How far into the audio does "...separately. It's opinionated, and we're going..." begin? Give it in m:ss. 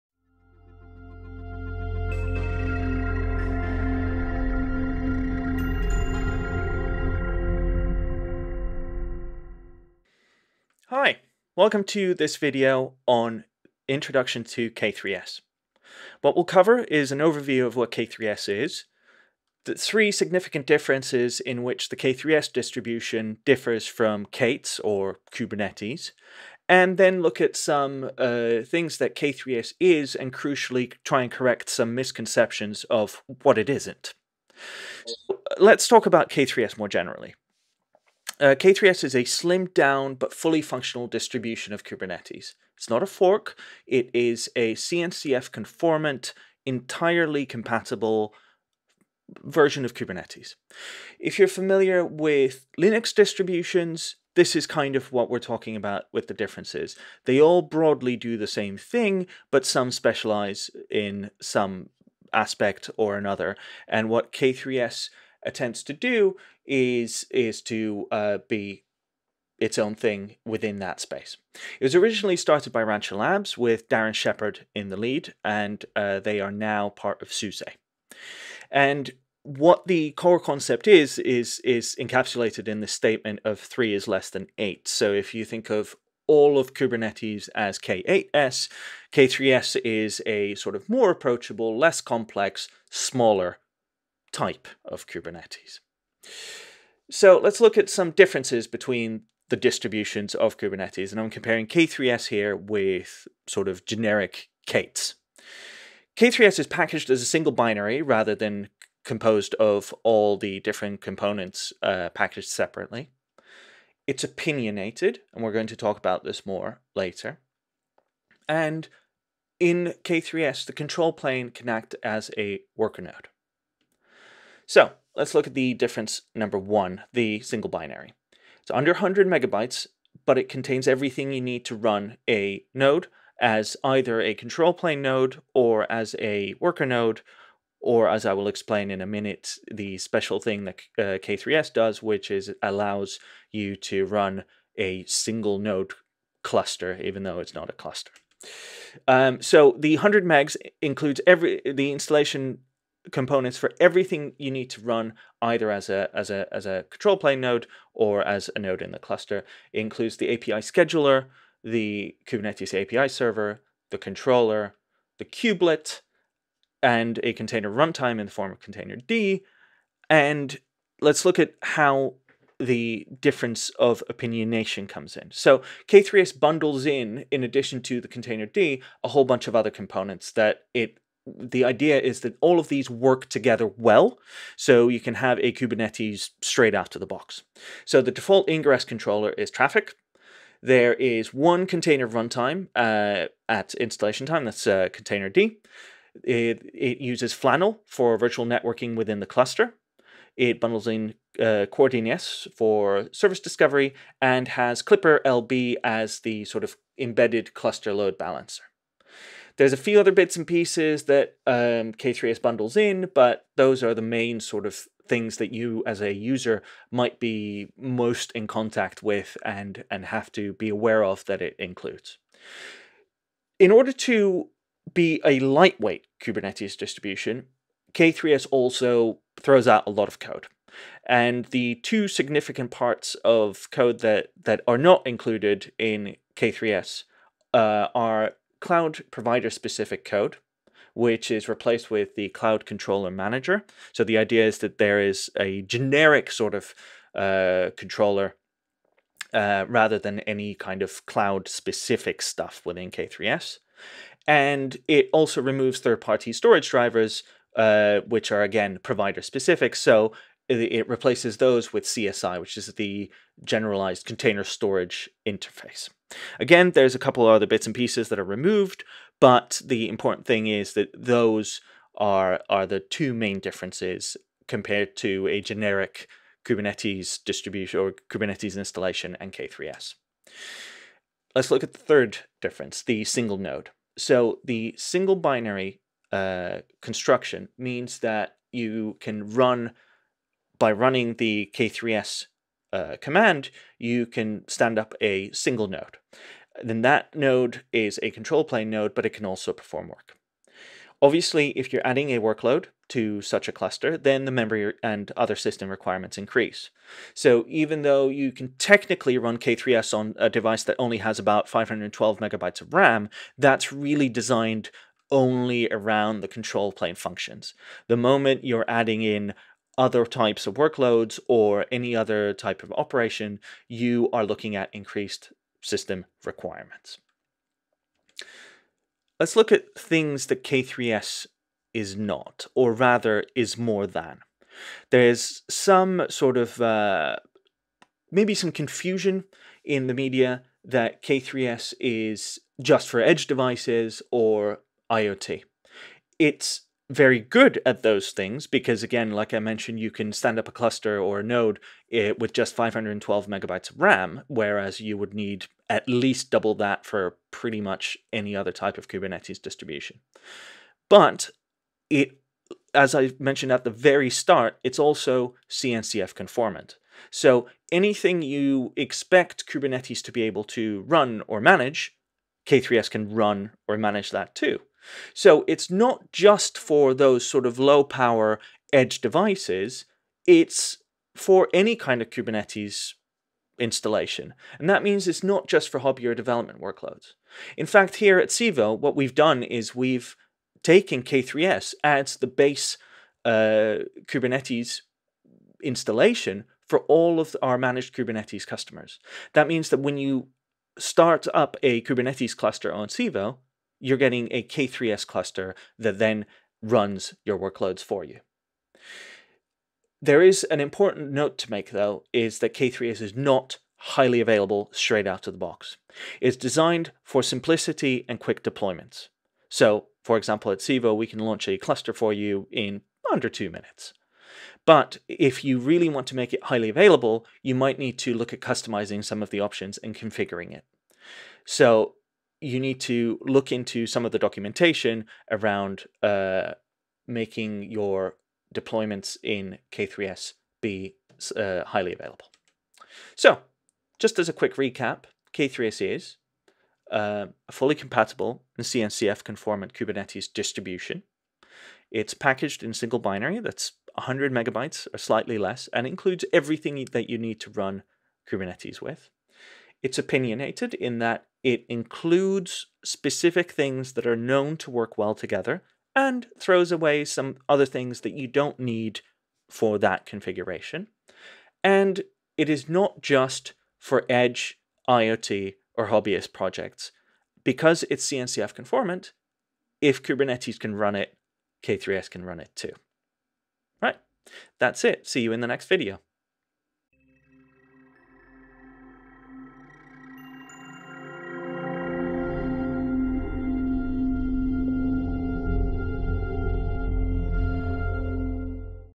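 1:52.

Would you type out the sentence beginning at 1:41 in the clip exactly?
And I'm comparing K3S here with sort of generic Kates.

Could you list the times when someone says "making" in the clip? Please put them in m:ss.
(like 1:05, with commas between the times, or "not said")
7:17.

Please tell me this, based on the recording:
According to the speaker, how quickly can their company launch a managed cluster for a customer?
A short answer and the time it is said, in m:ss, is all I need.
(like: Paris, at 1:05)
under 2 minutes, at 7:03.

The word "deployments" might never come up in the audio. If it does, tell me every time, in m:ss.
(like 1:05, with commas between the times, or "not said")
6:58, 7:18.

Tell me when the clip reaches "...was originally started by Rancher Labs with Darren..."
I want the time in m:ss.
1:11.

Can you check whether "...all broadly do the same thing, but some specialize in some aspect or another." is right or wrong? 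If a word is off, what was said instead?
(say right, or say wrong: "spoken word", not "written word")
right.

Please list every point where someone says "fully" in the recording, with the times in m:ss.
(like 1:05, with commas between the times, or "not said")
0:40, 7:27.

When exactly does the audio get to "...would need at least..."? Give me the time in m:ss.
5:54.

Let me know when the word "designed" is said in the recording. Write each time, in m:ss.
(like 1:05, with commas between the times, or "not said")
5:14, 6:56.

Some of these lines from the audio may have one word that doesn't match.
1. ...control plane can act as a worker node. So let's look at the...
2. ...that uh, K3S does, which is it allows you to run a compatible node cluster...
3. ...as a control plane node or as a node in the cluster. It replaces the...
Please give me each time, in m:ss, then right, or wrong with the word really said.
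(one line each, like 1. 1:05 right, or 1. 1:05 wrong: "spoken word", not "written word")
1. 2:00 right
2. 2:20 wrong: "single", not "compatible"
3. 2:36 wrong: "includes", not "replaces".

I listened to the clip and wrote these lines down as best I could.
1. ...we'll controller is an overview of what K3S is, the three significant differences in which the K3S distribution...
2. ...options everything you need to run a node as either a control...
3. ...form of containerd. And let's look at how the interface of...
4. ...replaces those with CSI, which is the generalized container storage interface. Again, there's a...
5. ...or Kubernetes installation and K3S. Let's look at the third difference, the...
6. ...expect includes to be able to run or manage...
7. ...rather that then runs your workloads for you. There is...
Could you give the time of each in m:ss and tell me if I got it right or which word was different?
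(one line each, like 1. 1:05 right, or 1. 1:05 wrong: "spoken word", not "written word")
1. 0:16 wrong: "cover", not "controller"
2. 2:10 wrong: "contains", not "options"
3. 2:48 wrong: "difference", not "interface"
4. 4:20 right
5. 4:37 right
6. 6:08 wrong: "kubernetes", not "includes"
7. 6:45 wrong: "cluster", not "rather".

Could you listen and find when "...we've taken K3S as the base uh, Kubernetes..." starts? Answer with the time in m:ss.
6:29.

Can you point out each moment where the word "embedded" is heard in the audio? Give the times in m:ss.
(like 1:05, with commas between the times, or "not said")
3:26.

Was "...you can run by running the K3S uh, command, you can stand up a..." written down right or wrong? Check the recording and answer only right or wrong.
right.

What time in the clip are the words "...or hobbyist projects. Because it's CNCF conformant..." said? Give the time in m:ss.
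7:55.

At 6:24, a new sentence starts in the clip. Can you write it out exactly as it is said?
And that means it's not just for hobby or development workloads.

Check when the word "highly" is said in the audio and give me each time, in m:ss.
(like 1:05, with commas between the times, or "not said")
6:53, 7:06, 7:21.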